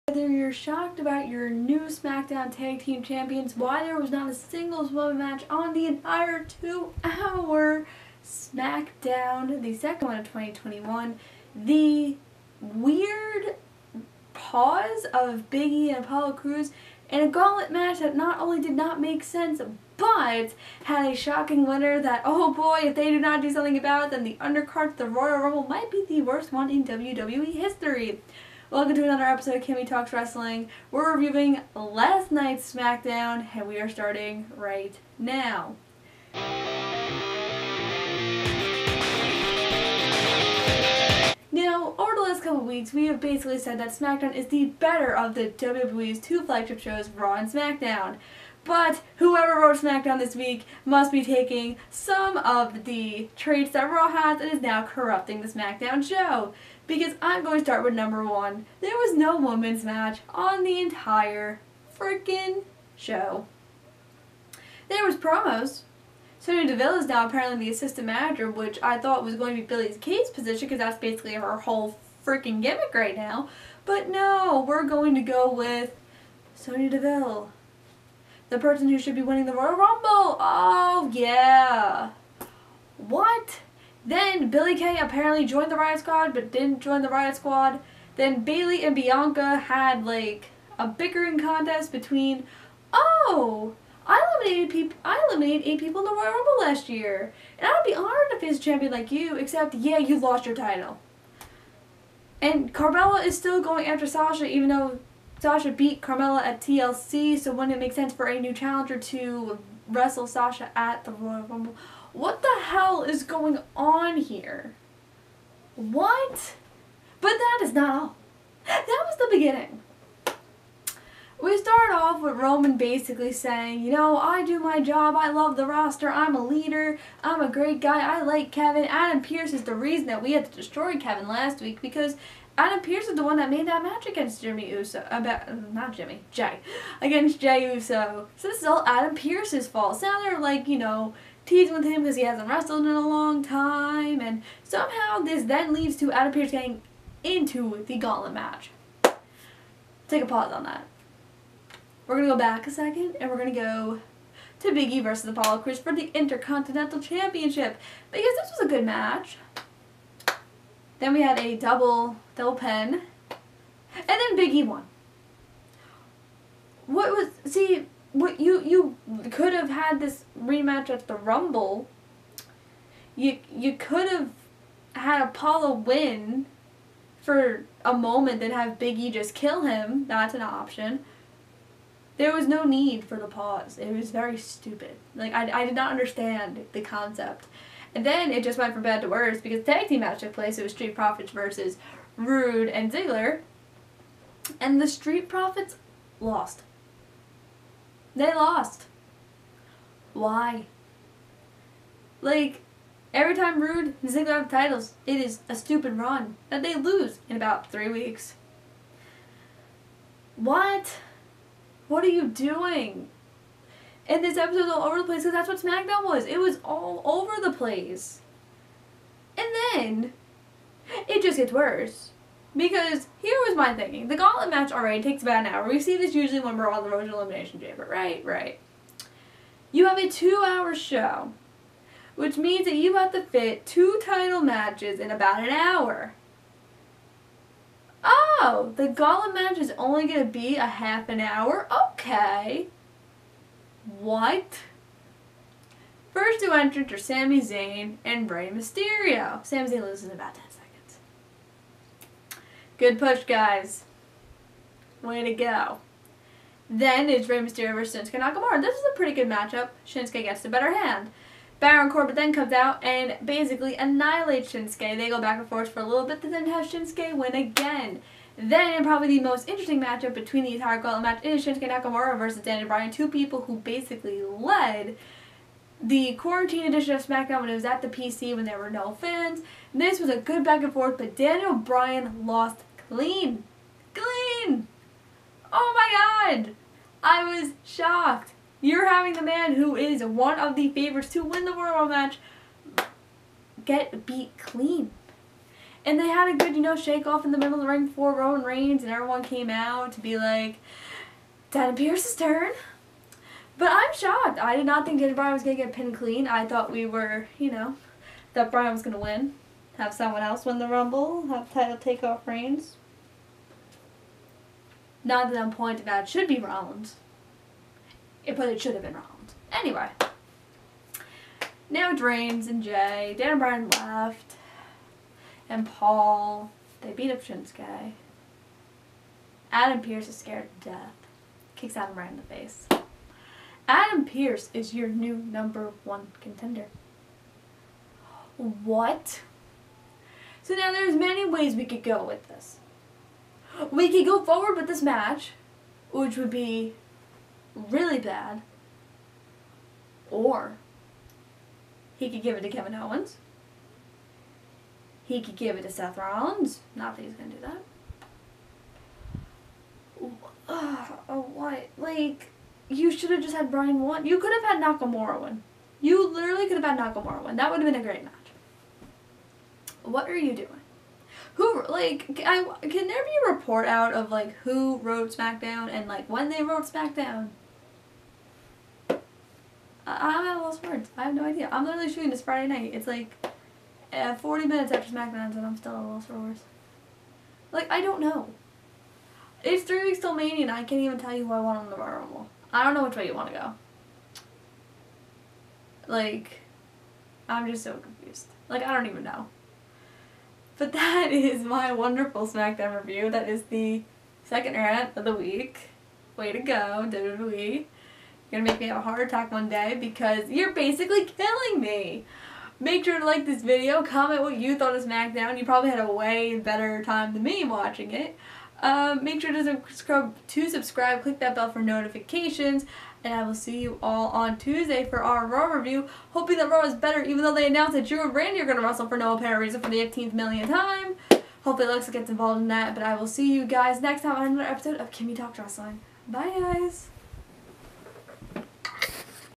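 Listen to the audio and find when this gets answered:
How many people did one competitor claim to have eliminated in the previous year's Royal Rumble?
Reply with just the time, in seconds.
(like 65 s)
95 s.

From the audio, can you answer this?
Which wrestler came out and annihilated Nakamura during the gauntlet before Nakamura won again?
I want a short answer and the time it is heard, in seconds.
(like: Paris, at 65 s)
Baron Corbin, at 261 s.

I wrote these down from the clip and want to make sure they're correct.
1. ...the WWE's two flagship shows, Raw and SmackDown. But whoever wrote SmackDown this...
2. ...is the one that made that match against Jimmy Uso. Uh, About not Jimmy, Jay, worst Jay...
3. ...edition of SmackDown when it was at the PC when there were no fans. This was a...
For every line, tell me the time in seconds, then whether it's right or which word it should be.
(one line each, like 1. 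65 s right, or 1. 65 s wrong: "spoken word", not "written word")
1. 45 s right
2. 133 s wrong: "against", not "worst"
3. 276 s right.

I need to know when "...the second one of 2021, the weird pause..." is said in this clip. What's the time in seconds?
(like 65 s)
9 s.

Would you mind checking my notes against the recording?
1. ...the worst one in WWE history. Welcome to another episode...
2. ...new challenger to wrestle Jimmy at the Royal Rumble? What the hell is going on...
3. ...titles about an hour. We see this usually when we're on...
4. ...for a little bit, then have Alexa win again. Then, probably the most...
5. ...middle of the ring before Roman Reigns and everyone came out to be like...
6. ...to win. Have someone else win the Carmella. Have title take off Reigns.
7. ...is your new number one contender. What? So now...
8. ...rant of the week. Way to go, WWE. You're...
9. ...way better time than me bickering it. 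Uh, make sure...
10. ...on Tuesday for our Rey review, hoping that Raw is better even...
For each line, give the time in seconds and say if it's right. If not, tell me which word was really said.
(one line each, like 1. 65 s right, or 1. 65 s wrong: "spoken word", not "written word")
1. 26 s right
2. 108 s wrong: "Sasha", not "Jimmy"
3. 225 s wrong: "takes", not "titles"
4. 265 s wrong: "Shinsuke", not "Alexa"
5. 297 s right
6. 308 s wrong: "Rumble", not "Carmella"
7. 334 s right
8. 404 s right
9. 415 s wrong: "watching", not "bickering"
10. 424 s wrong: "Raw", not "Rey".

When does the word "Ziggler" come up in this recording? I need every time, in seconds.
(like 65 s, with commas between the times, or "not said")
192 s, 204 s.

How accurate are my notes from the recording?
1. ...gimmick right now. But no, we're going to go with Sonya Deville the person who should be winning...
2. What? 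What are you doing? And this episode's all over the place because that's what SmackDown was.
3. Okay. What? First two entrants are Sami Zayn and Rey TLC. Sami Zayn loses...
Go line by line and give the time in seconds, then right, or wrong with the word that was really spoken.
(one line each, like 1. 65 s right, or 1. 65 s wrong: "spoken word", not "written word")
1. 72 s right
2. 210 s right
3. 241 s wrong: "Mysterio", not "TLC".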